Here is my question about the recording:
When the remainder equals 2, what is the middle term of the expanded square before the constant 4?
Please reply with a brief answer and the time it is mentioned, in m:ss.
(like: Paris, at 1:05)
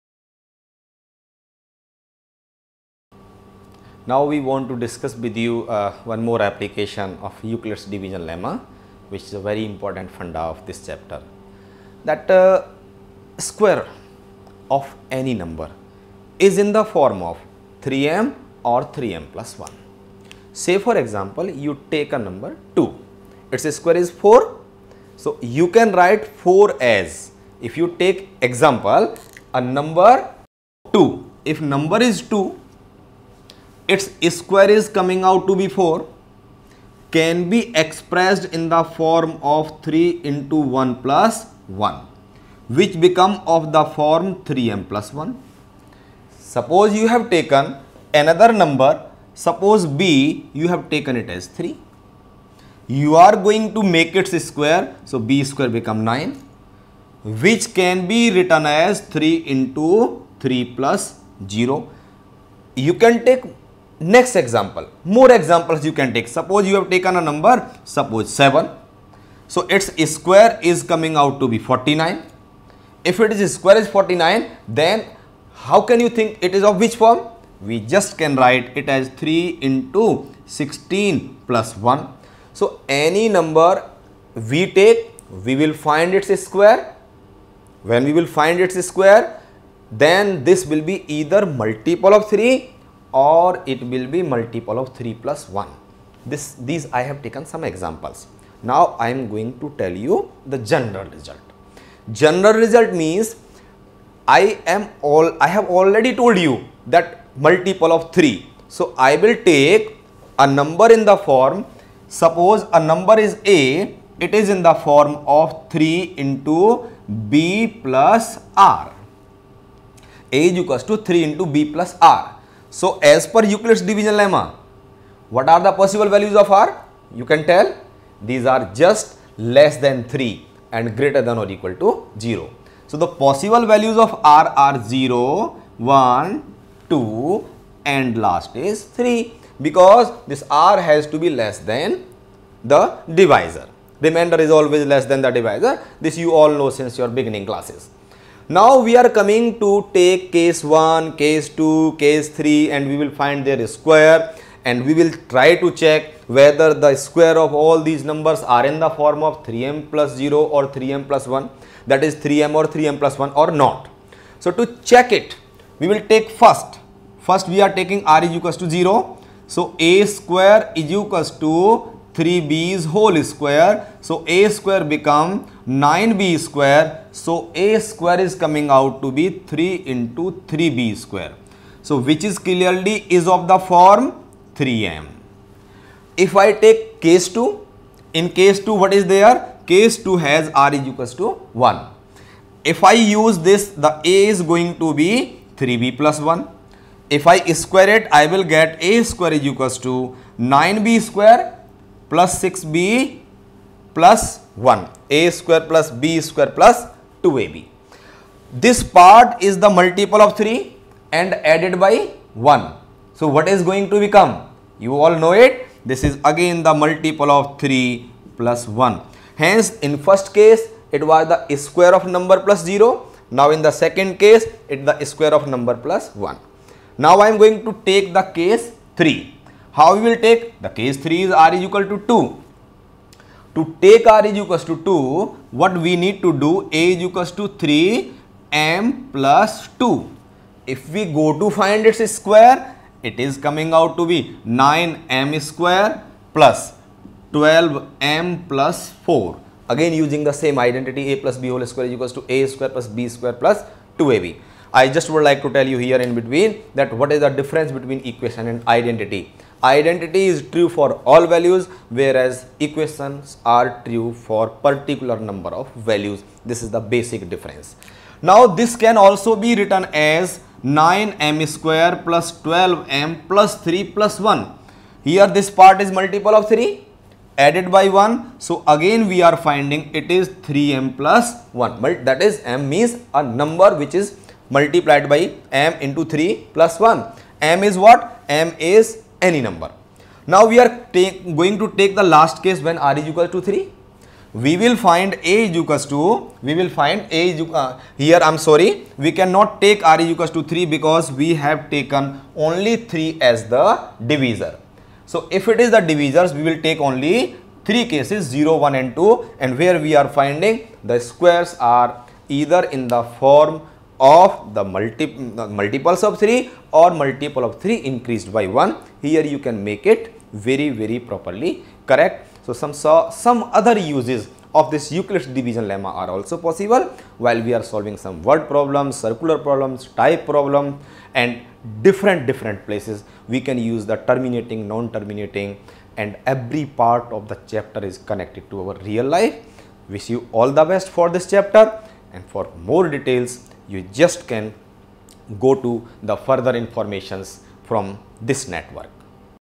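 12m, at 4:07.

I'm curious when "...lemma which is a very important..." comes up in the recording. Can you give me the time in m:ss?
0:08.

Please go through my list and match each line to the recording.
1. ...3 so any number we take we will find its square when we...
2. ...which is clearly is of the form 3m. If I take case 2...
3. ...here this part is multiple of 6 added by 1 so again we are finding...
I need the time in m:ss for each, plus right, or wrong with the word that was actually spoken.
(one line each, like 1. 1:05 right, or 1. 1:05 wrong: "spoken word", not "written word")
1. 1:21 wrong: "1", not "3"
2. 3:01 right
3. 4:35 wrong: "3", not "6".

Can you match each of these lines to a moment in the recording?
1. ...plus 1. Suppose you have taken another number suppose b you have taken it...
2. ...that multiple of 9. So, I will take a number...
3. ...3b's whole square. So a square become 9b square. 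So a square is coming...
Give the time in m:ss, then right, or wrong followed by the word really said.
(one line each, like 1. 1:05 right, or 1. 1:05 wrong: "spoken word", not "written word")
1. 0:44 right
2. 1:46 wrong: "3", not "9"
3. 2:52 right.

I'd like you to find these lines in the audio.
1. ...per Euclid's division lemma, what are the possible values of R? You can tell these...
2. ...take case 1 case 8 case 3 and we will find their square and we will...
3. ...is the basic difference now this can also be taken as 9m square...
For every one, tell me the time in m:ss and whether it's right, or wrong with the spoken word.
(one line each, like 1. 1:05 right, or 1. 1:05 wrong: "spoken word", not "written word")
1. 2:03 right
2. 2:29 wrong: "2", not "8"
3. 4:26 wrong: "written", not "taken".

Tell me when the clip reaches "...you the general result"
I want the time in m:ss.
1:39.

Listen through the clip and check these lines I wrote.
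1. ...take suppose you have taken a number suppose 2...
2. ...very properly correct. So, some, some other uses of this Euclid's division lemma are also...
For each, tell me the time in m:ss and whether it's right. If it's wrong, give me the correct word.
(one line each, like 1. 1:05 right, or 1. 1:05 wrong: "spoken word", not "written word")
1. 1:06 wrong: "7", not "2"
2. 5:20 right.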